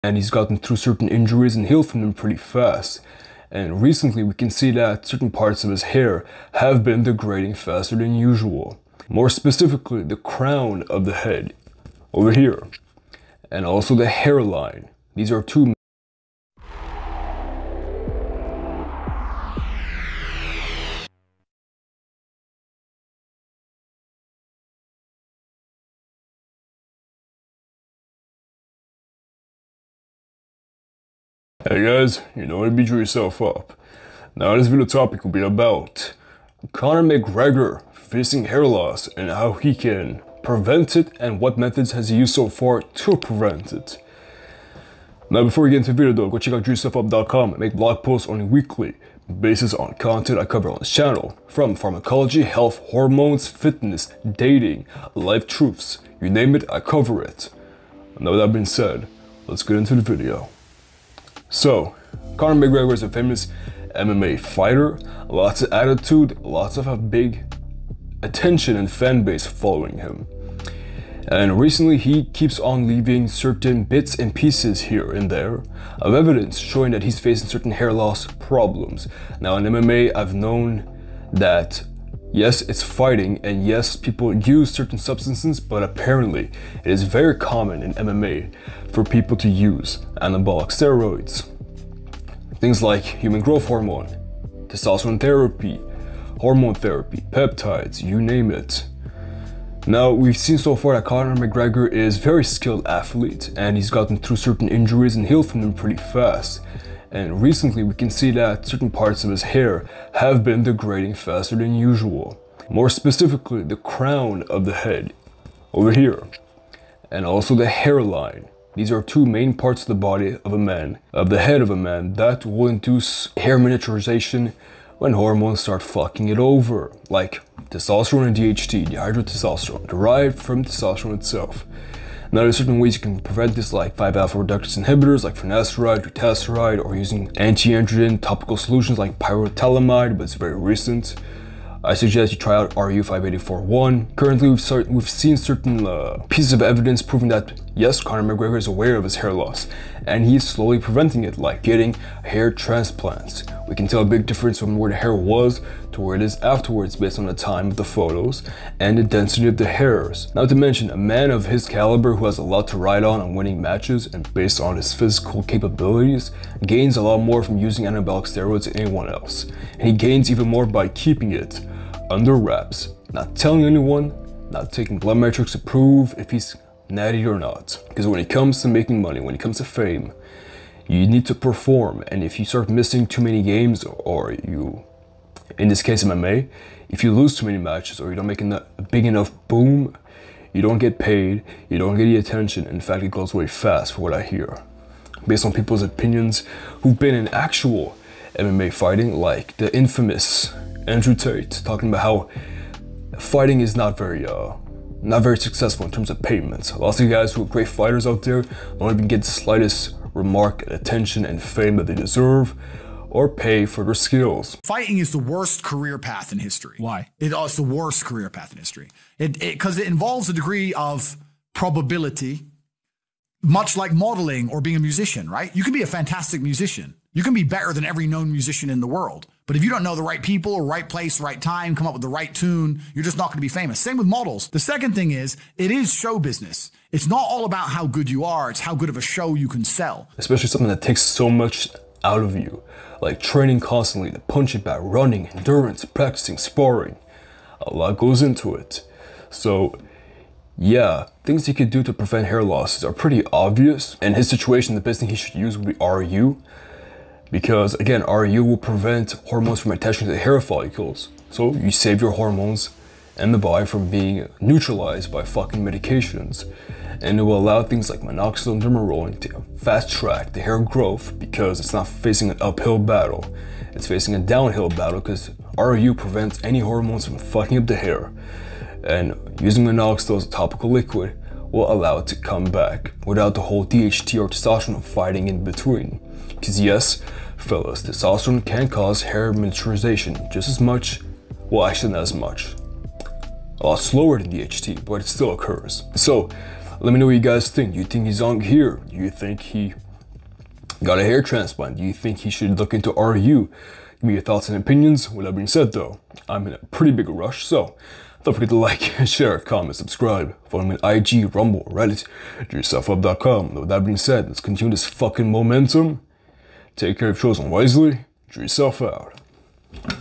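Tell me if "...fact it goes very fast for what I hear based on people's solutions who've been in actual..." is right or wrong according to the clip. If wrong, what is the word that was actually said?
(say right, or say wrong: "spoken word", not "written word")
wrong: "opinions", not "solutions".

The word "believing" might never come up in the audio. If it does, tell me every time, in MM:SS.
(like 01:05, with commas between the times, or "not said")
not said.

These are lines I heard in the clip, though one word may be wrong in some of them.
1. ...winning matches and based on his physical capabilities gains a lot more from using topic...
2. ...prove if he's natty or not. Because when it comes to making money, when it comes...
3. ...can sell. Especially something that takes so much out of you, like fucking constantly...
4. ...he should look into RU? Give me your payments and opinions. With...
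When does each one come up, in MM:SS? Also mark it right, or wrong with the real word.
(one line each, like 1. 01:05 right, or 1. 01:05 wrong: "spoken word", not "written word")
1. 02:43 wrong: "anabolic", not "topic"
2. 02:55 right
3. 03:59 wrong: "training", not "fucking"
4. 05:02 wrong: "thoughts", not "payments".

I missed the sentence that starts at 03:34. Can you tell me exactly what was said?
Fighting is the worst career path in history.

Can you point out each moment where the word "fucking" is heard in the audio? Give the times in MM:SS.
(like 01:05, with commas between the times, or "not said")
02:05, 04:25, 04:37, 05:14.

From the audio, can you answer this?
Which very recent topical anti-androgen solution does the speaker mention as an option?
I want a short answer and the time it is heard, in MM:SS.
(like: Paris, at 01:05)
Pyrilutamide, at 02:19.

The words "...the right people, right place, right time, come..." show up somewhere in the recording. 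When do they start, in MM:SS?
03:49.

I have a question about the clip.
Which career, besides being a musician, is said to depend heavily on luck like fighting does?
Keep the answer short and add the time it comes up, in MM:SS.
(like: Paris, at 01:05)
Modeling, at 03:43.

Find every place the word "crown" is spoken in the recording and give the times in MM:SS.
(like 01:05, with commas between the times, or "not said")
00:10, 01:53.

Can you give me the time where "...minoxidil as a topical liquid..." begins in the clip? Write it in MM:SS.
04:39.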